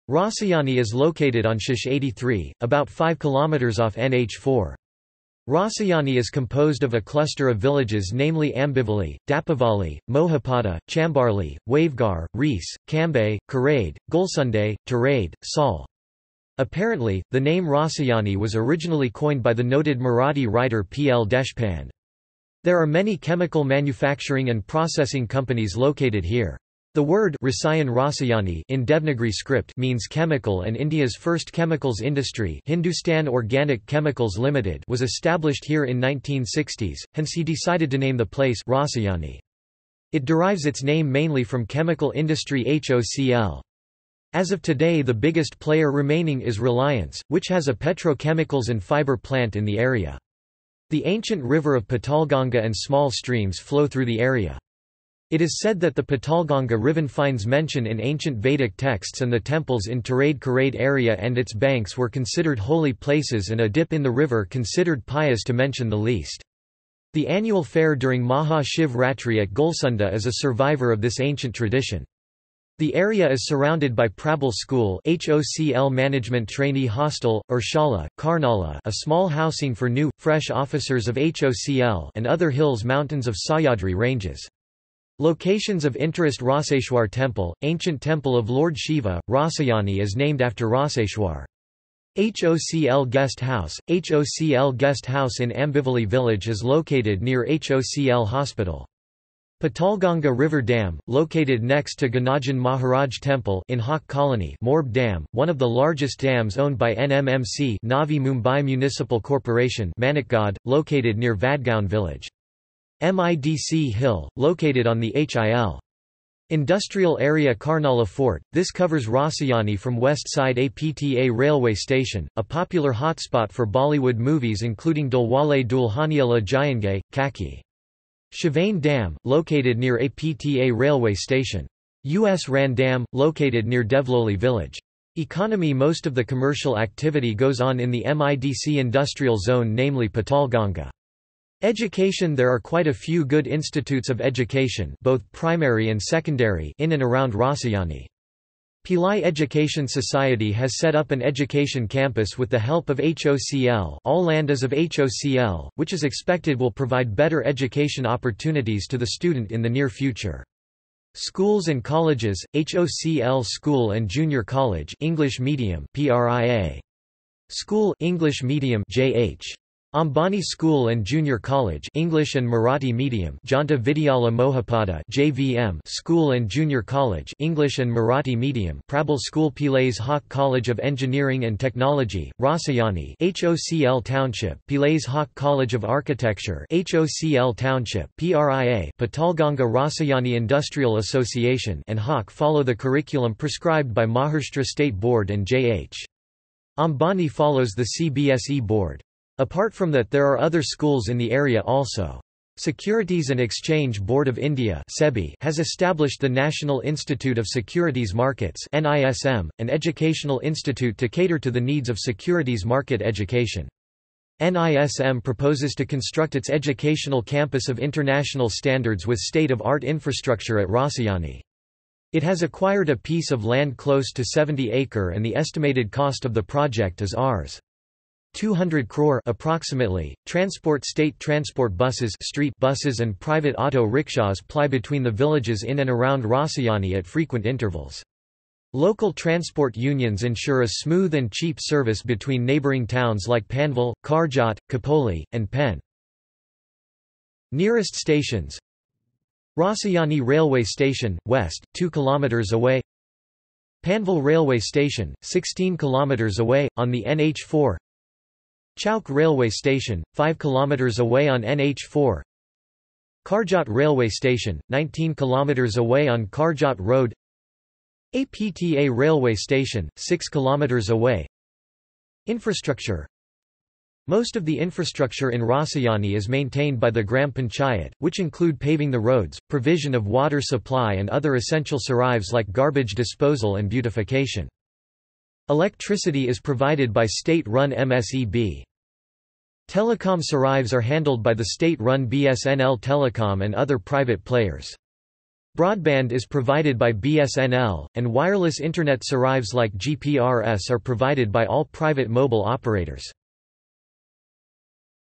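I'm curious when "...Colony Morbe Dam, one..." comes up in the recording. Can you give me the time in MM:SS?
01:44.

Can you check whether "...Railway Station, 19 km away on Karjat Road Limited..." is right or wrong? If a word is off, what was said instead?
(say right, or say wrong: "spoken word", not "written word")
wrong: "APTA", not "Limited".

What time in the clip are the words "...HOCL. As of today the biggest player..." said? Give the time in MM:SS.
00:42.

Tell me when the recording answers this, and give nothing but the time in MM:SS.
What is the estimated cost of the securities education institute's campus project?
03:47.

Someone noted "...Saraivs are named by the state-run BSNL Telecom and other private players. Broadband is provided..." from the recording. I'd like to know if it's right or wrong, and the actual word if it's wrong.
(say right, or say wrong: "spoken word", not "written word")
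wrong: "handled", not "named".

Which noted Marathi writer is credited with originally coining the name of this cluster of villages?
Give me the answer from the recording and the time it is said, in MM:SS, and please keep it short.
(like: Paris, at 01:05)
P. L. Deshpande, at 00:20.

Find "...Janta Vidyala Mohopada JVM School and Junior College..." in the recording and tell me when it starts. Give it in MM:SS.
02:53.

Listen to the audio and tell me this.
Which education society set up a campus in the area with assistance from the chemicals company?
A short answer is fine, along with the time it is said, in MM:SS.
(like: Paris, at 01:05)
Pillai Education Society, at 02:28.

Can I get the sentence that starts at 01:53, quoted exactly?
MIDC Hill, located on the HIL.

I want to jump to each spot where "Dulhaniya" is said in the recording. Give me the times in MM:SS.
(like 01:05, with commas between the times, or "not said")
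02:05.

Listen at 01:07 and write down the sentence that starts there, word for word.
The annual fair during Maha Shiv Ratri at Gulsunde is a survivor of this ancient tradition.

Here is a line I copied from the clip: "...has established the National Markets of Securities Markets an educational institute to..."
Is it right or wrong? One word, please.
wrong.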